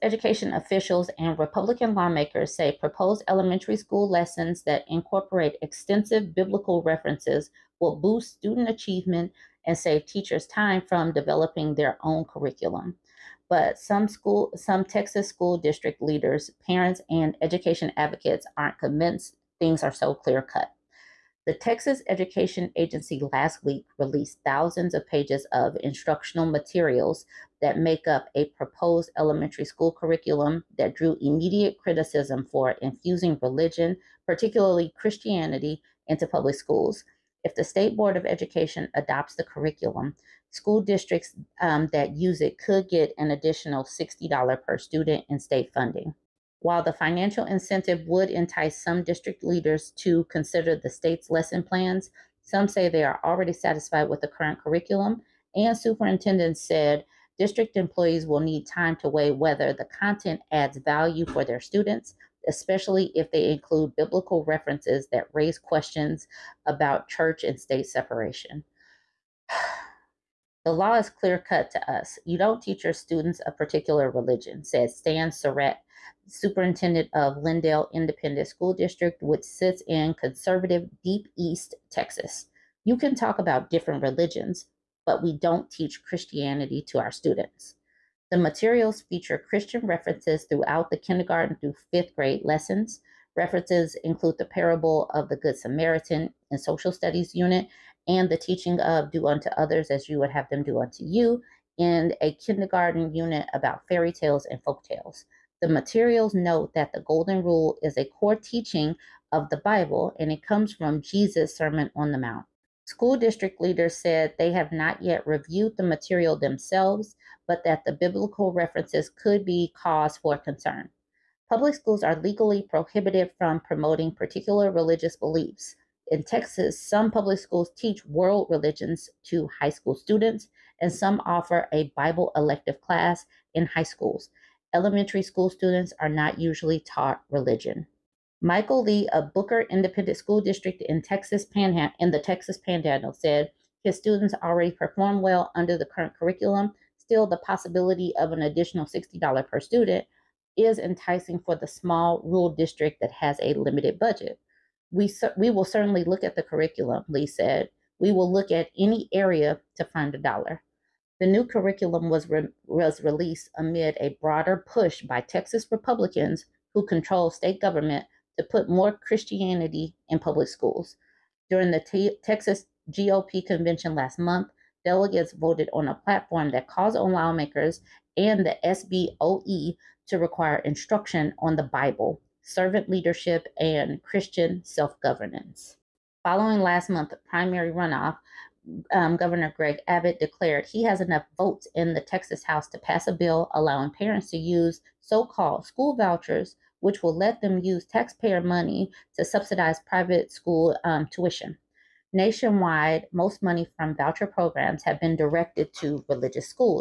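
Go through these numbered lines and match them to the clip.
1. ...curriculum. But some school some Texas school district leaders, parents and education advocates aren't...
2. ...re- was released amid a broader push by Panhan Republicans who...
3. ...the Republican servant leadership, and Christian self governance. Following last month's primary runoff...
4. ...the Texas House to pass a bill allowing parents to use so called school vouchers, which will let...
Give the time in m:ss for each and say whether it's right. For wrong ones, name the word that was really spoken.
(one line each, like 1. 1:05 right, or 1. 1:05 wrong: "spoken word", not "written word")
1. 0:12 right
2. 2:42 wrong: "Texas", not "Panhan"
3. 3:01 wrong: "Bible", not "Republican"
4. 3:11 right.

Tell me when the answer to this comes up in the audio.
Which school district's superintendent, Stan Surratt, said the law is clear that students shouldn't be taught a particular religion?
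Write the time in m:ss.
1:17.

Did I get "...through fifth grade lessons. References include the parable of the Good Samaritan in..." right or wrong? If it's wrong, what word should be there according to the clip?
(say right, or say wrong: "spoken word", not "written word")
right.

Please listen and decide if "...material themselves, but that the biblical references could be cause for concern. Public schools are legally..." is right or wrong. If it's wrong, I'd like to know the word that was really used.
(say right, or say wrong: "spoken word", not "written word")
right.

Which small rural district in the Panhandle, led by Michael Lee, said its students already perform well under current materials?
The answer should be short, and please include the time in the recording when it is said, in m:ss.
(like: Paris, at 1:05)
Booker Independent School District, at 2:19.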